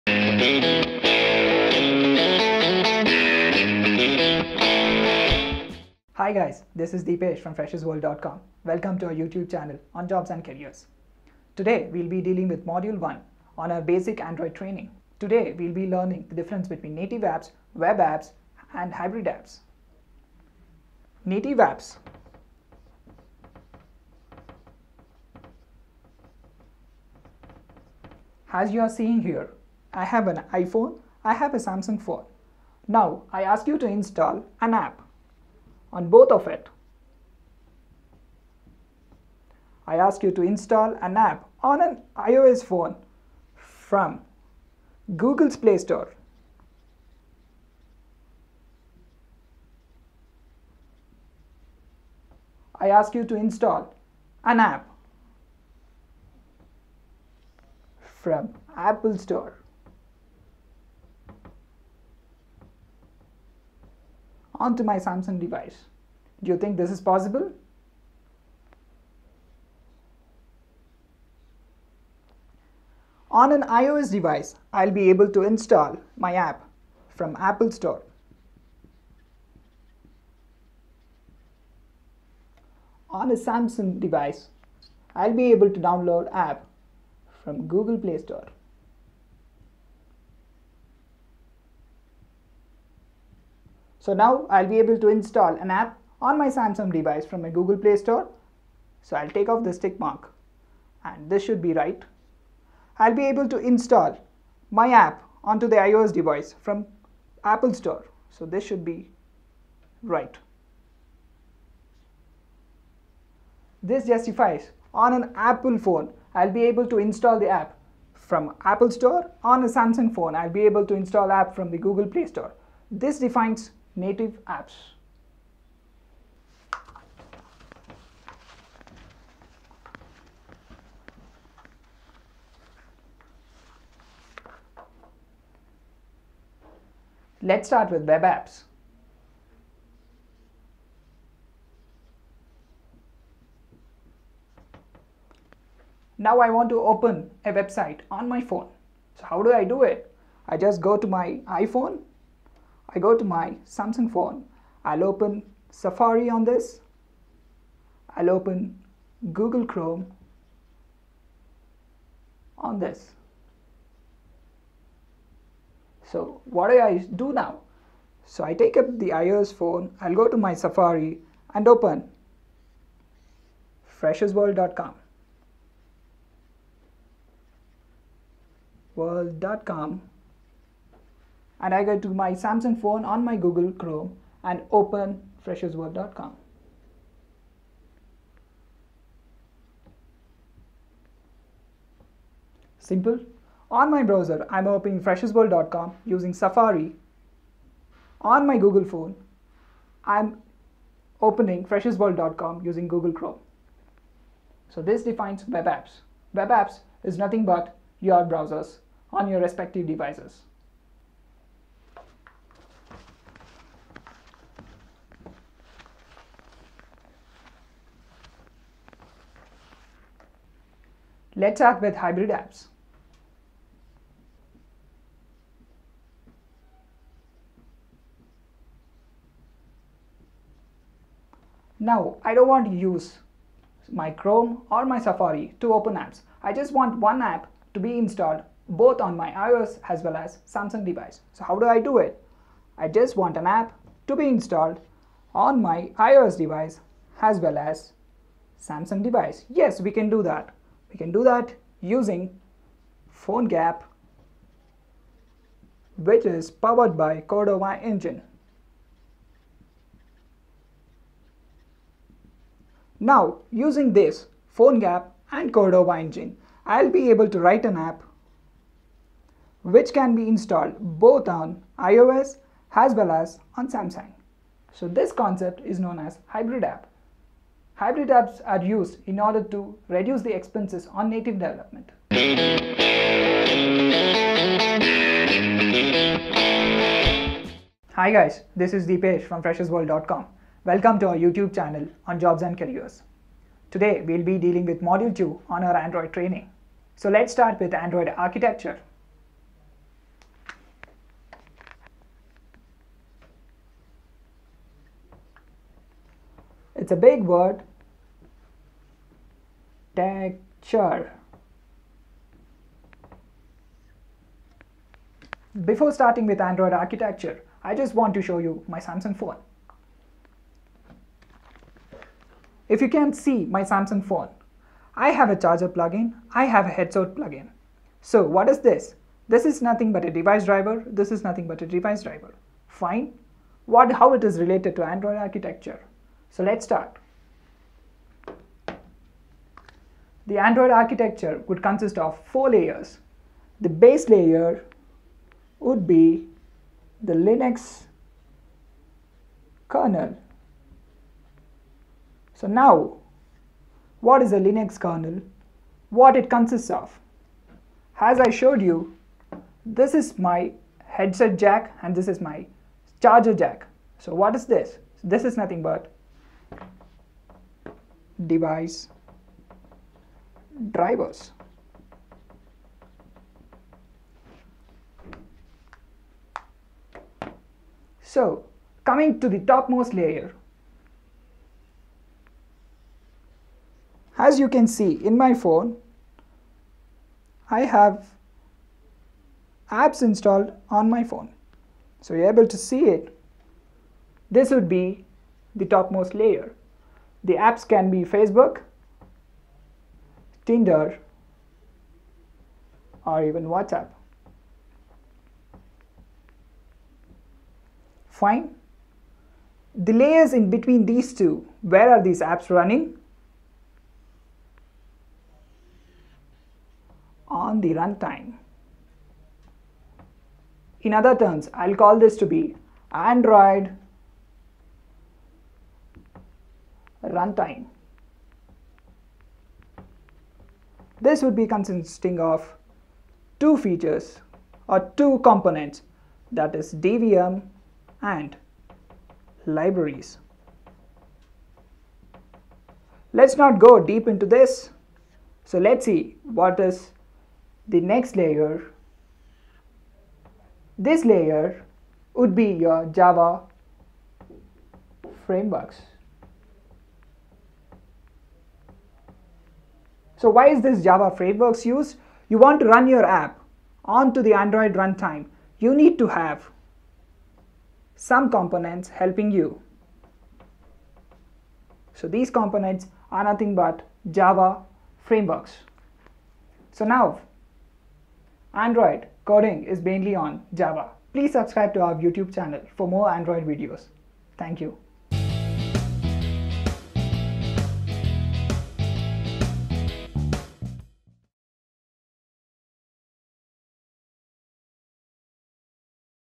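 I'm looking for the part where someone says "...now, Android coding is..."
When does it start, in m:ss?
7:56.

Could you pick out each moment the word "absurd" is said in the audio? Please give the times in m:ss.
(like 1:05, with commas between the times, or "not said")
not said.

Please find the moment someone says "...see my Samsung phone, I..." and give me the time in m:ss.
5:23.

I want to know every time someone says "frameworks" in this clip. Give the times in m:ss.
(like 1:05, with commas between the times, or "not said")
7:35, 7:41, 7:55.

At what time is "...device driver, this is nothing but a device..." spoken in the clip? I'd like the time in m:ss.
5:30.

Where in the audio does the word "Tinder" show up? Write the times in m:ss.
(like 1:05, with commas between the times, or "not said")
6:40.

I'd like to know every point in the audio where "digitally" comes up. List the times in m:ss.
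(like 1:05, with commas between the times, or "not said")
not said.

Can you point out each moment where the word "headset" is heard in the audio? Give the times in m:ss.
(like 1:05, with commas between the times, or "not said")
5:26, 6:00.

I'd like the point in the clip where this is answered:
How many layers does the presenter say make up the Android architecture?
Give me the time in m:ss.
5:42.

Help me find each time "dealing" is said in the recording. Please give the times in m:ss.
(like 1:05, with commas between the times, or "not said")
0:12, 4:54.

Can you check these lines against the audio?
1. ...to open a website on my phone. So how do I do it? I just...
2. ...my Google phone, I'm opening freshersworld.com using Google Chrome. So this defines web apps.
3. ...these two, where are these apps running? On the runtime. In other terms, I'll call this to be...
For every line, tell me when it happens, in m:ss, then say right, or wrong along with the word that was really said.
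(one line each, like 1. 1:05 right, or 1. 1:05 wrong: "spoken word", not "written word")
1. 2:26 right
2. 3:18 right
3. 6:50 right.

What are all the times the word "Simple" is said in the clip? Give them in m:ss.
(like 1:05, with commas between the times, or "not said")
3:12.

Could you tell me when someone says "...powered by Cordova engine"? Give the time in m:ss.
4:16.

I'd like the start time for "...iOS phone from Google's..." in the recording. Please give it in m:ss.
0:42.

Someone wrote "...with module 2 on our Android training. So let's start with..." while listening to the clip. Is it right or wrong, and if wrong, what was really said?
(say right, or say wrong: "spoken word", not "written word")
right.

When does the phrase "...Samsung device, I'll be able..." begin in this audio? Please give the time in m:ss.
1:23.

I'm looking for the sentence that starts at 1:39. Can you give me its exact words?
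So I'll take off this tick mark and this should be right.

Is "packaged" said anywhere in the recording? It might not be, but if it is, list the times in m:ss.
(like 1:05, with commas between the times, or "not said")
not said.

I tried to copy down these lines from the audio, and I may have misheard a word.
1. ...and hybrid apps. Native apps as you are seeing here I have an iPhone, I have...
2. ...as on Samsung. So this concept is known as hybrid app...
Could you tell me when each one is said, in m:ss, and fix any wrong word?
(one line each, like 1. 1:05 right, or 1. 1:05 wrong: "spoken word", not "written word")
1. 0:18 right
2. 4:33 right.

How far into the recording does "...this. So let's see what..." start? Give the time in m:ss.
7:24.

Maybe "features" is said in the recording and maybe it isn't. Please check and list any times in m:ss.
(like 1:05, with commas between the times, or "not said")
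7:13.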